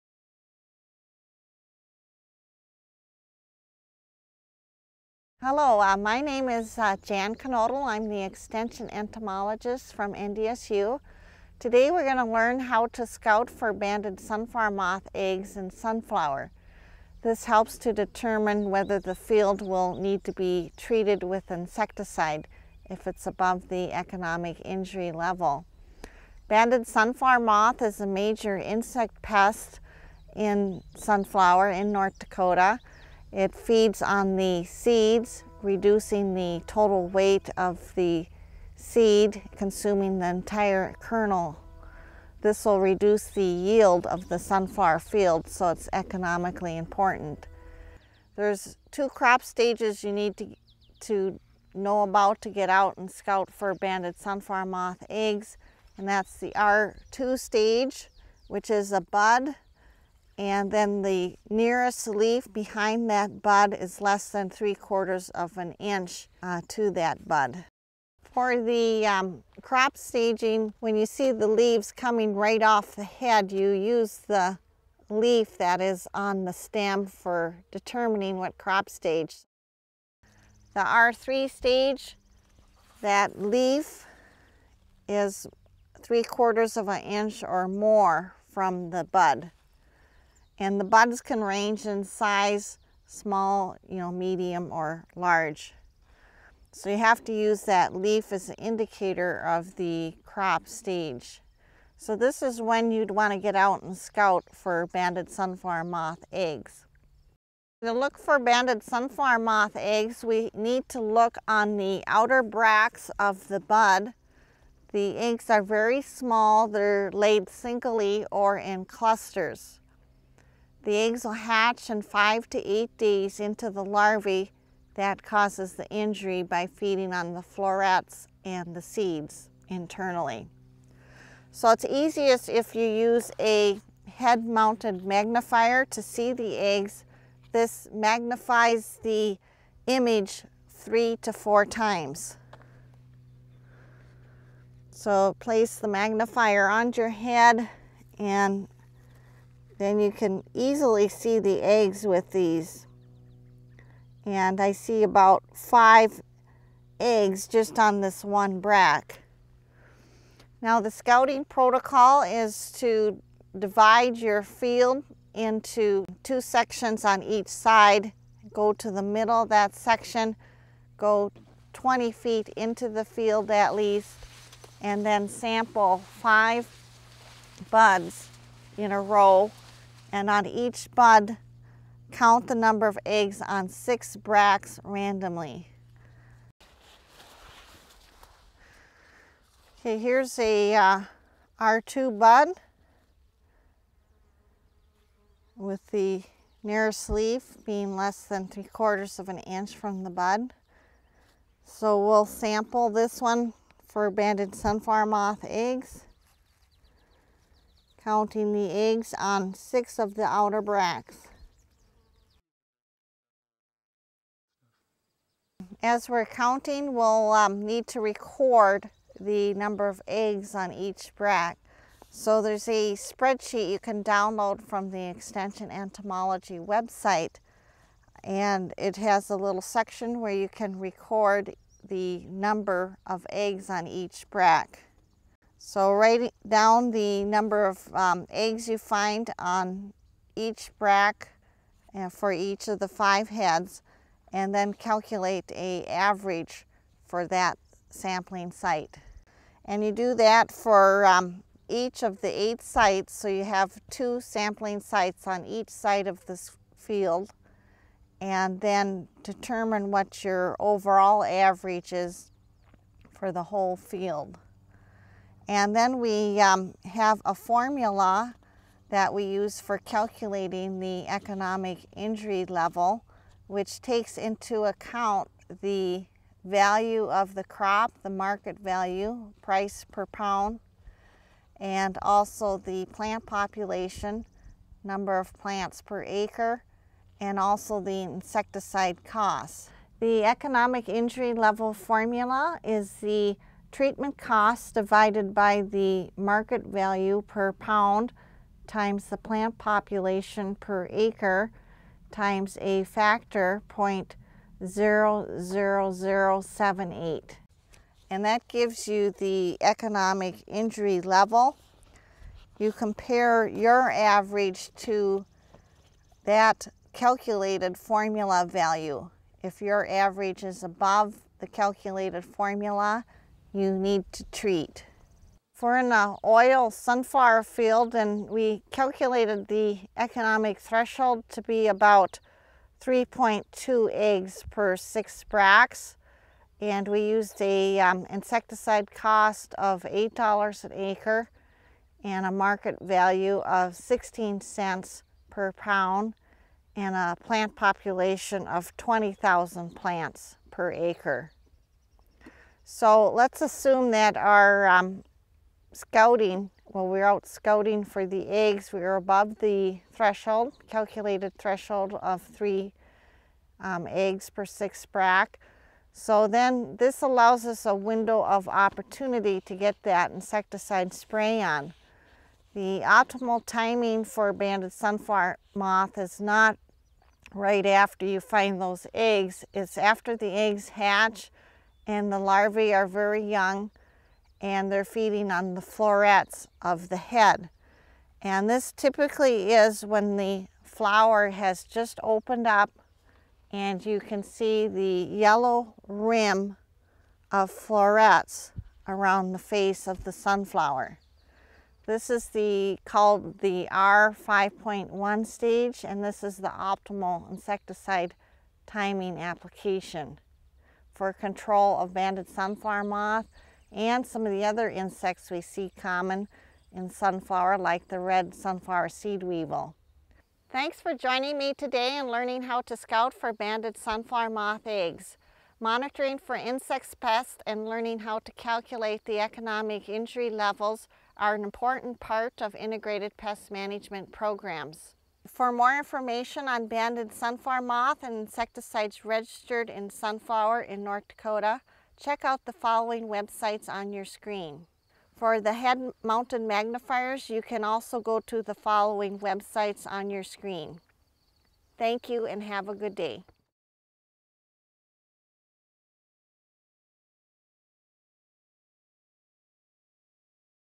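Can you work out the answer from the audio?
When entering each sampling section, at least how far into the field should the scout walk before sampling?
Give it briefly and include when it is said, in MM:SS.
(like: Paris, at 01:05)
20 feet, at 02:51.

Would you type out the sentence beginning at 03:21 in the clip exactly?
So we'll sample this one for banded sunflower moth eggs counting the eggs on six of the outer bracts.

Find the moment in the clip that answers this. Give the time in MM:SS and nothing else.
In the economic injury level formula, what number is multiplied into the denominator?
05:03.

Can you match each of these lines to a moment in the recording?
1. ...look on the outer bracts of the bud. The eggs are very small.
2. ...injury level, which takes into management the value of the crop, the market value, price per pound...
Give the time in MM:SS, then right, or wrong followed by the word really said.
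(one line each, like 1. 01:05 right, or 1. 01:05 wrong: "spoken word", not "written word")
1. 01:51 right
2. 04:31 wrong: "account", not "management".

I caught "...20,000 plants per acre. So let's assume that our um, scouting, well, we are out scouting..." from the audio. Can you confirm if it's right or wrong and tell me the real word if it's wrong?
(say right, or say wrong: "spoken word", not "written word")
right.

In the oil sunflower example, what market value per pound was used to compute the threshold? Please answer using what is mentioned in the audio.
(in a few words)
16 cents.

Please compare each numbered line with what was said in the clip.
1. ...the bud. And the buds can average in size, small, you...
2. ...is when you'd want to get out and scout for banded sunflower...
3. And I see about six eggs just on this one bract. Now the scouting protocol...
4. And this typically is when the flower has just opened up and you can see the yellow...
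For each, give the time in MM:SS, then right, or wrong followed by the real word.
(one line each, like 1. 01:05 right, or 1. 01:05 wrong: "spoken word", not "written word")
1. 01:28 wrong: "range", not "average"
2. 01:42 right
3. 02:34 wrong: "five", not "six"
4. 06:28 right.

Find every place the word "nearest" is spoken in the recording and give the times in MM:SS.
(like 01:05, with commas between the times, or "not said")
01:01, 03:16.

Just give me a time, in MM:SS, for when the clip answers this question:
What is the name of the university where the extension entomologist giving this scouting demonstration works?
00:10.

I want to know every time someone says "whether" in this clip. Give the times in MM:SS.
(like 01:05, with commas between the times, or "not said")
00:18.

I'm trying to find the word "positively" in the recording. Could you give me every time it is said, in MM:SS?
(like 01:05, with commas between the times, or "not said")
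not said.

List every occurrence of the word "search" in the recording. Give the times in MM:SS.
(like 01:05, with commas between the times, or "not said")
not said.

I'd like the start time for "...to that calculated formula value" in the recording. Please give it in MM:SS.
05:14.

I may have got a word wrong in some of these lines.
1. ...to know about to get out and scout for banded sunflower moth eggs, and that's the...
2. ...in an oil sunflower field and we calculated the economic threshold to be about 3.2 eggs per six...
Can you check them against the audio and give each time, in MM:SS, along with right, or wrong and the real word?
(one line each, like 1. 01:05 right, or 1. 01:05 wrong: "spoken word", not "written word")
1. 00:51 right
2. 05:25 right.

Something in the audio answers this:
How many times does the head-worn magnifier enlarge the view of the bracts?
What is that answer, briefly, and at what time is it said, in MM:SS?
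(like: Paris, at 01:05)
3 to 4 times, at 02:20.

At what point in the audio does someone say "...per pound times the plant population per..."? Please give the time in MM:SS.
04:57.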